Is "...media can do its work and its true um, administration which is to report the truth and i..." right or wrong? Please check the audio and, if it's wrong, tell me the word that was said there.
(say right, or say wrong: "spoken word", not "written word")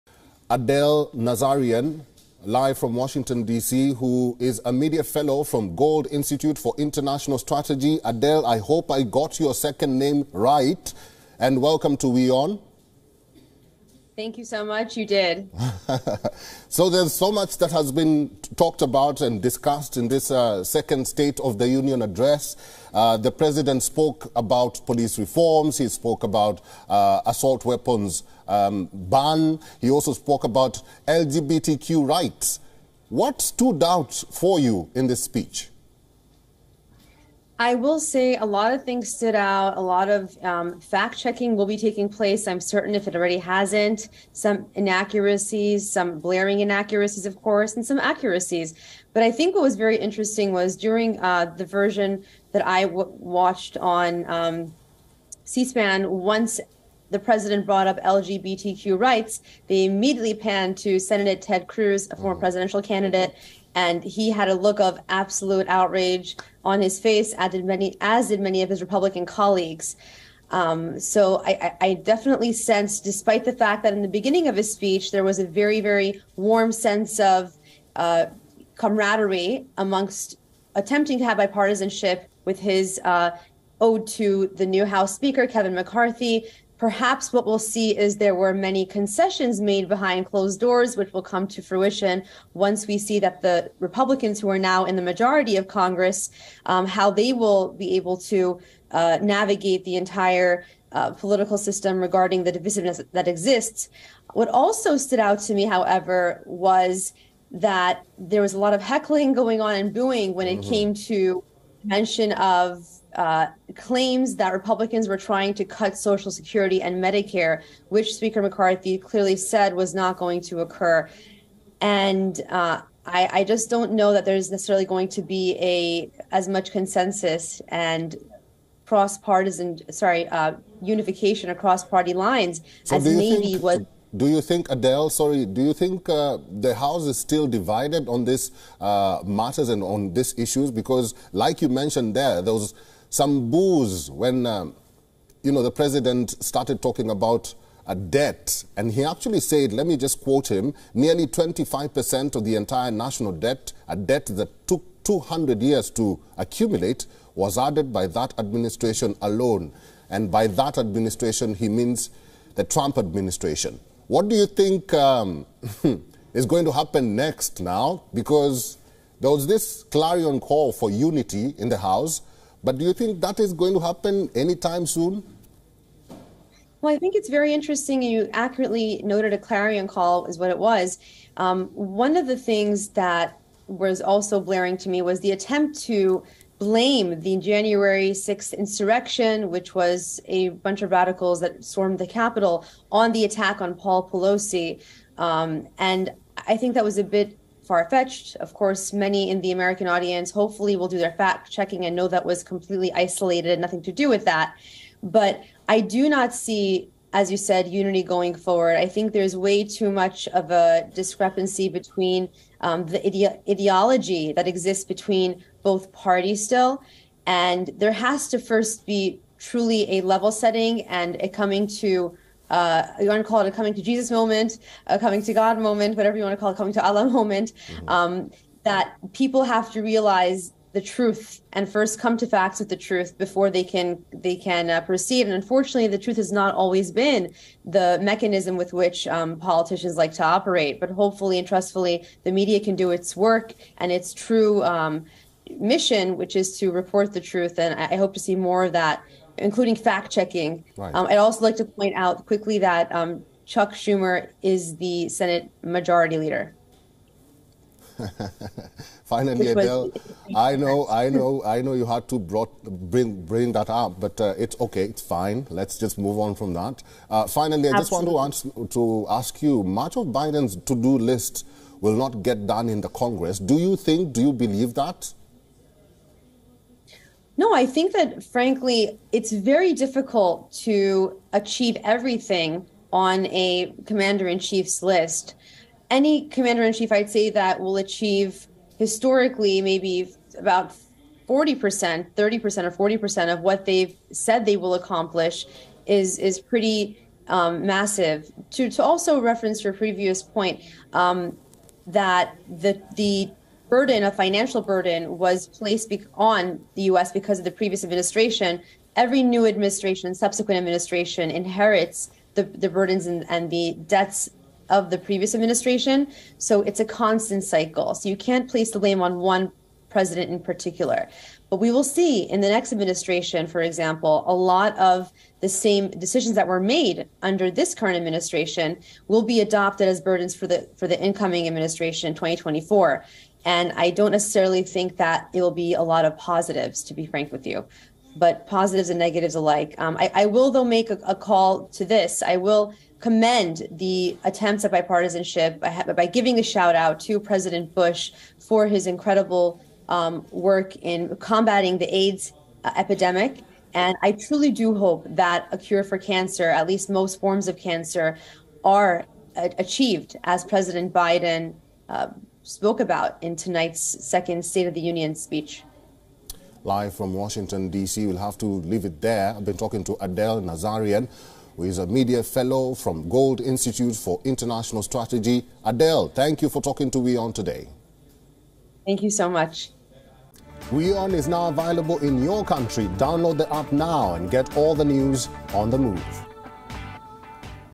wrong: "mission", not "administration".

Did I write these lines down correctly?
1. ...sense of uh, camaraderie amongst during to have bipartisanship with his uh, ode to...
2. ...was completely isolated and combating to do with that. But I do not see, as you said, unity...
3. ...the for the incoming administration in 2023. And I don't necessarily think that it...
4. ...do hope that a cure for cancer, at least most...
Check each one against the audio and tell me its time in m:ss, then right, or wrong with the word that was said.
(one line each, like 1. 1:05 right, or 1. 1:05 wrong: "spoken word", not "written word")
1. 1:16 wrong: "attempting", not "during"
2. 3:22 wrong: "nothing", not "combating"
3. 5:30 wrong: "2024", not "2023"
4. 5:54 right.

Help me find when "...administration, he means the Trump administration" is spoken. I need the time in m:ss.
2:40.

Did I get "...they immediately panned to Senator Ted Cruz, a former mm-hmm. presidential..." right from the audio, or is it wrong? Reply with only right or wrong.
right.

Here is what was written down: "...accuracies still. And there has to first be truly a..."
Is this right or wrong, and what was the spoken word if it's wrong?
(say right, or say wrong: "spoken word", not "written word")
wrong: "parties", not "accuracies".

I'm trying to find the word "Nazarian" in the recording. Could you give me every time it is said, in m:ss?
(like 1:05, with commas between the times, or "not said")
0:01, 6:10.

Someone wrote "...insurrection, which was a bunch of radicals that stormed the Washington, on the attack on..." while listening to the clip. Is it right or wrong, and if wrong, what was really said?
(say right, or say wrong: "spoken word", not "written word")
wrong: "Capitol", not "Washington".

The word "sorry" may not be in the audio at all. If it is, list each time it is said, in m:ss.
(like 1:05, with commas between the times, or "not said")
2:09, 2:15.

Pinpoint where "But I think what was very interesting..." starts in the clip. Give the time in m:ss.
0:49.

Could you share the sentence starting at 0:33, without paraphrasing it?
What stood out for you in this speech?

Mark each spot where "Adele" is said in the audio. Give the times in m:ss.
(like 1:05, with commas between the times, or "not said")
0:00, 0:08, 2:14, 4:19, 6:09, 6:15.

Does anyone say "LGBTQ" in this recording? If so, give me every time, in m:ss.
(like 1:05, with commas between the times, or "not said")
0:31, 0:58.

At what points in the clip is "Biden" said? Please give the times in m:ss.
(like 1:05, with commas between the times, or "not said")
4:30, 6:00.